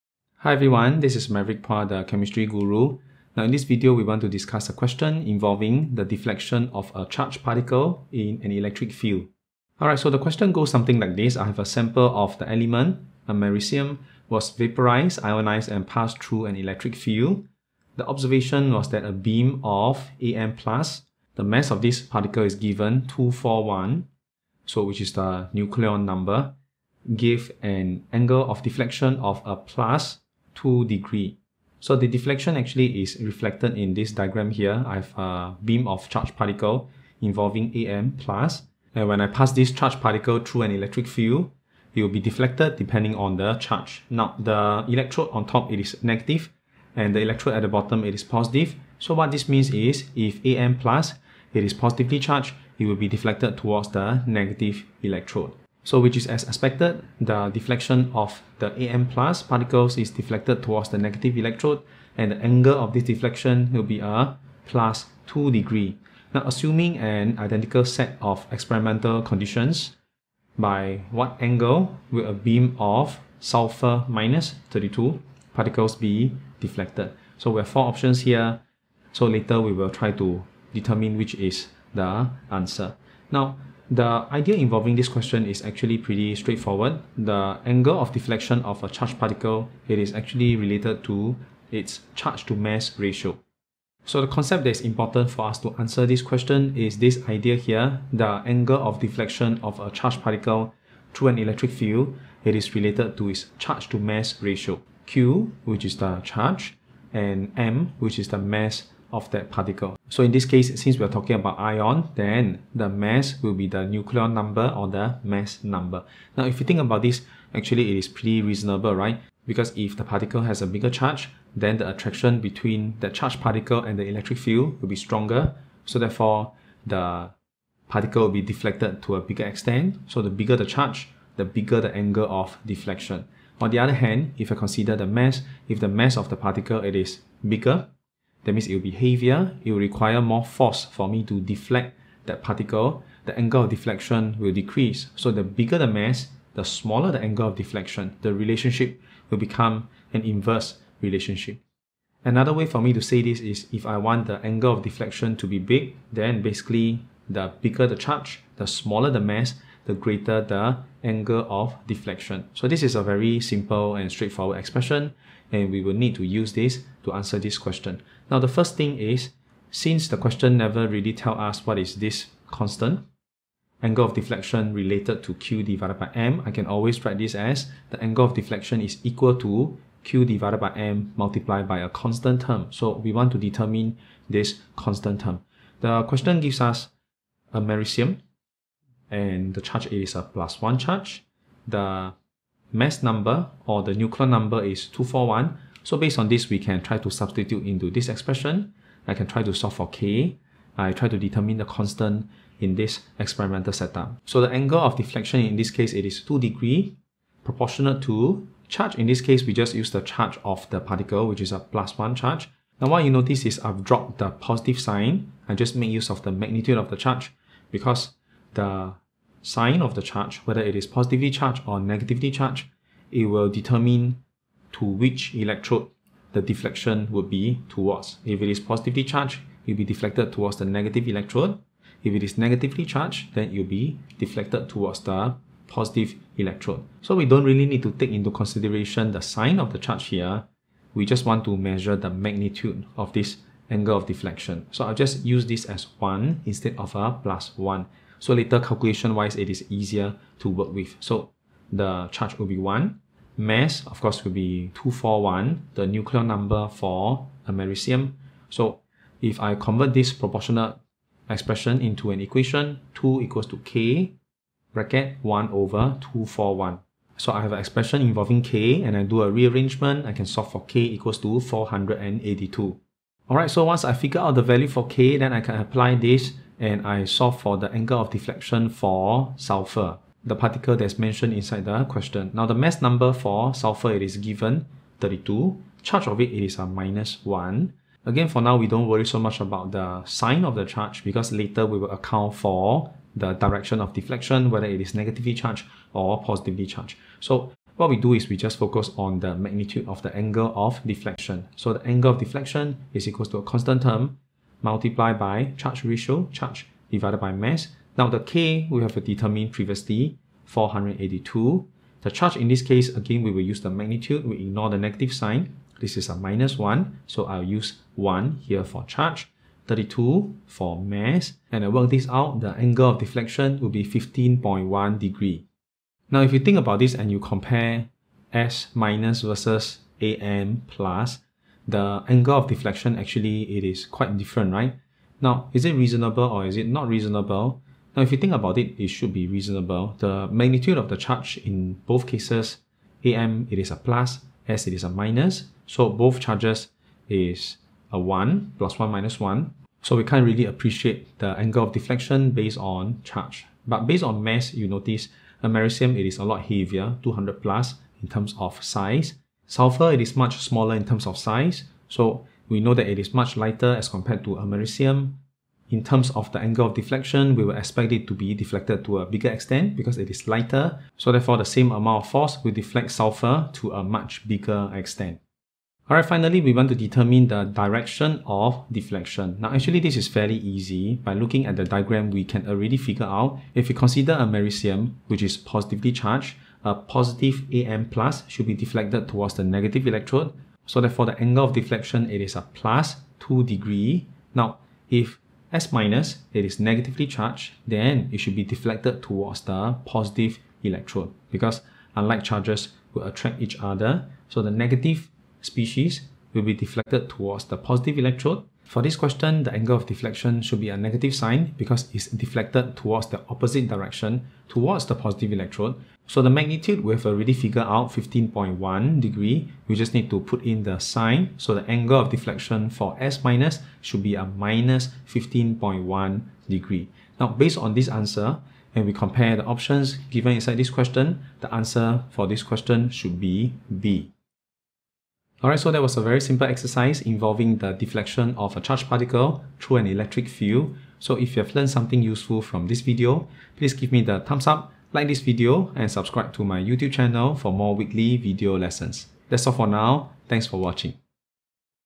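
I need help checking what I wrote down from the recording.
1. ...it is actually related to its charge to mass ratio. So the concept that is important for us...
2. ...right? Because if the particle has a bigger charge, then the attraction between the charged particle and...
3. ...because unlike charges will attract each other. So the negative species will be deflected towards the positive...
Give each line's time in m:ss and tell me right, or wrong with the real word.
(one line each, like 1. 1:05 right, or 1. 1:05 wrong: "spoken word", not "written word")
1. 1:29 right
2. 1:58 right
3. 6:41 right.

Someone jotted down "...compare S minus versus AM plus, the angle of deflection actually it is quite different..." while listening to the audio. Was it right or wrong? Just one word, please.
right.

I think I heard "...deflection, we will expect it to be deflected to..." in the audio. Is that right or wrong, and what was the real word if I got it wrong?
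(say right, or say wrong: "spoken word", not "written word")
right.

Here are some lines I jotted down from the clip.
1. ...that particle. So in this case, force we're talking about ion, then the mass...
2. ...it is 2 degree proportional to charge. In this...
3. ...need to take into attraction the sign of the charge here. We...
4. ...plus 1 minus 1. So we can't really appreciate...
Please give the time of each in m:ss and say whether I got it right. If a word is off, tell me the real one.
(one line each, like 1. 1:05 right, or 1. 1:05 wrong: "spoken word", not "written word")
1. 1:49 wrong: "since", not "force"
2. 3:25 right
3. 3:57 wrong: "consideration", not "attraction"
4. 5:48 right.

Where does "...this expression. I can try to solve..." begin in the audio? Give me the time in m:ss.
3:17.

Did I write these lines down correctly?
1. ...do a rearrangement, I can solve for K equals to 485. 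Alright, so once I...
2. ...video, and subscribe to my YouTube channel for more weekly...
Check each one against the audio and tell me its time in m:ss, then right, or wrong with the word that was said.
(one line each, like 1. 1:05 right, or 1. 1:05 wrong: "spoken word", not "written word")
1. 4:29 wrong: "482", not "485"
2. 7:25 right.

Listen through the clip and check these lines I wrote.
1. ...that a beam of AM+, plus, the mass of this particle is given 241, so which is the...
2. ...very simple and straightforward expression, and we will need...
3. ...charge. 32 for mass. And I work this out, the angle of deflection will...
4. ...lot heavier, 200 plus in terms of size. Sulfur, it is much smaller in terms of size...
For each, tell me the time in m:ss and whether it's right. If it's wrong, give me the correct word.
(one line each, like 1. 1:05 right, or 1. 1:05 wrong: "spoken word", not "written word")
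1. 0:18 right
2. 2:43 right
3. 5:18 right
4. 5:56 right.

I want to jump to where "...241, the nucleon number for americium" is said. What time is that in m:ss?
4:14.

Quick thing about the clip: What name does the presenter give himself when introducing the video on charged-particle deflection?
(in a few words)
the chemistry guru.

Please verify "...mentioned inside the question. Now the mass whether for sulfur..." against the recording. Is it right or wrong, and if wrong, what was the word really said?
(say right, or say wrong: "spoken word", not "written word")
wrong: "number", not "whether".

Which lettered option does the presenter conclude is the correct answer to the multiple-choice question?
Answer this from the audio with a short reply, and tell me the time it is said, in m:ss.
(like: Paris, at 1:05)
B, at 7:13.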